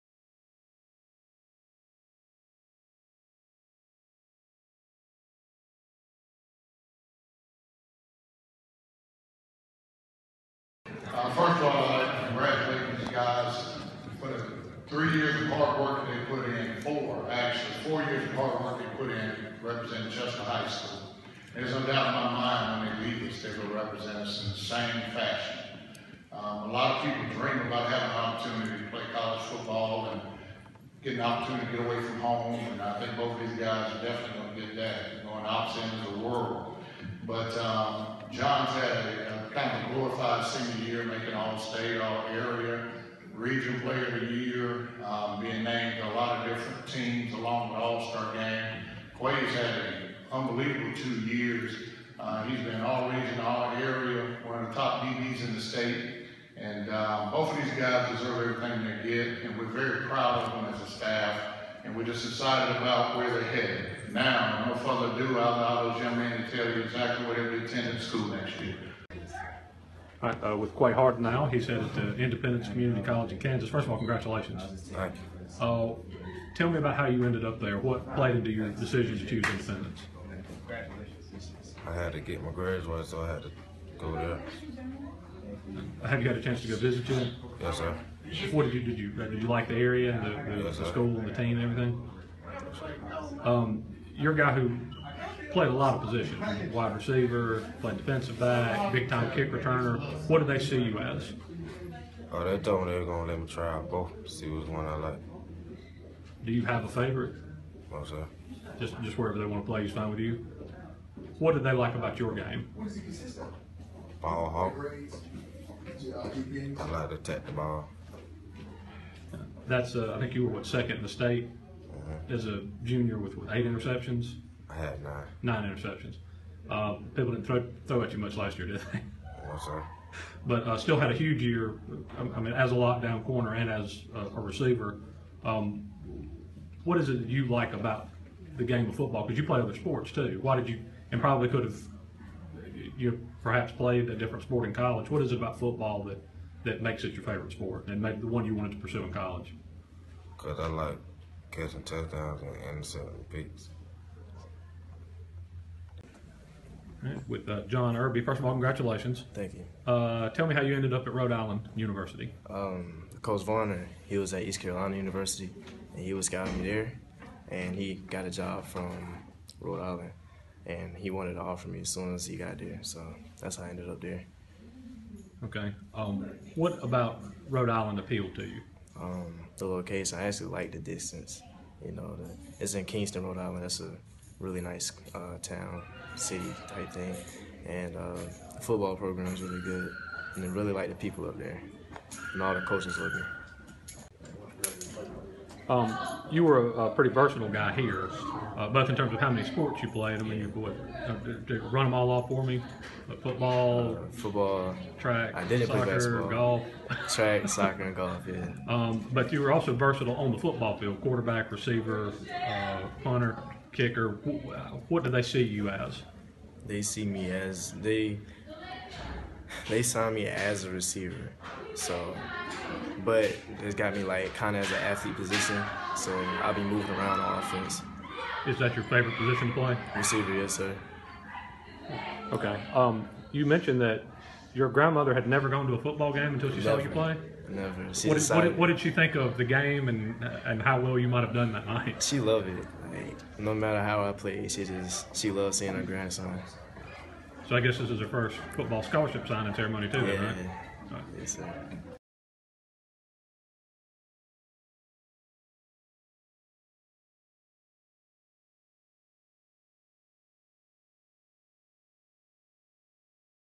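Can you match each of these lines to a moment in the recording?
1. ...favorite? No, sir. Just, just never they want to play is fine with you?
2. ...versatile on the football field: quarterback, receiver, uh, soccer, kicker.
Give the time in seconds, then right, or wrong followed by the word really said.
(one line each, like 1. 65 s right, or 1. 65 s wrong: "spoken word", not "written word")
1. 106 s wrong: "wherever", not "never"
2. 209 s wrong: "punter", not "soccer".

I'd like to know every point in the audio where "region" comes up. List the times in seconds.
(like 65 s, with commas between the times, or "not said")
43 s, 52 s.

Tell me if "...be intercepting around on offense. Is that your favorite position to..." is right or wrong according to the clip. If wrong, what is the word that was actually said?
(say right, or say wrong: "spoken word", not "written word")
wrong: "moving", not "intercepting".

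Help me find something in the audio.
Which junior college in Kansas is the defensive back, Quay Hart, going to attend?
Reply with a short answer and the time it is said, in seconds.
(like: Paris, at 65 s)
Independence Community College, at 72 s.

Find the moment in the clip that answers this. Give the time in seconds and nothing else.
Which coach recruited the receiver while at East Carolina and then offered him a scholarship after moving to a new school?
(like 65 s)
163 s.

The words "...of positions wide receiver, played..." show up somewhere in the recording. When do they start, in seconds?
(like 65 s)
95 s.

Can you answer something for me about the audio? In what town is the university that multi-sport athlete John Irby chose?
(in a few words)
Kingston.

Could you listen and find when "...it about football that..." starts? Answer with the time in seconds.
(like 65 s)
145 s.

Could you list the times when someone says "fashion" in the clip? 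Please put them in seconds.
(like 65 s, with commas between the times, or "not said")
25 s.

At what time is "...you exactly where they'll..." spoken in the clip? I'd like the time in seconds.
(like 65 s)
66 s.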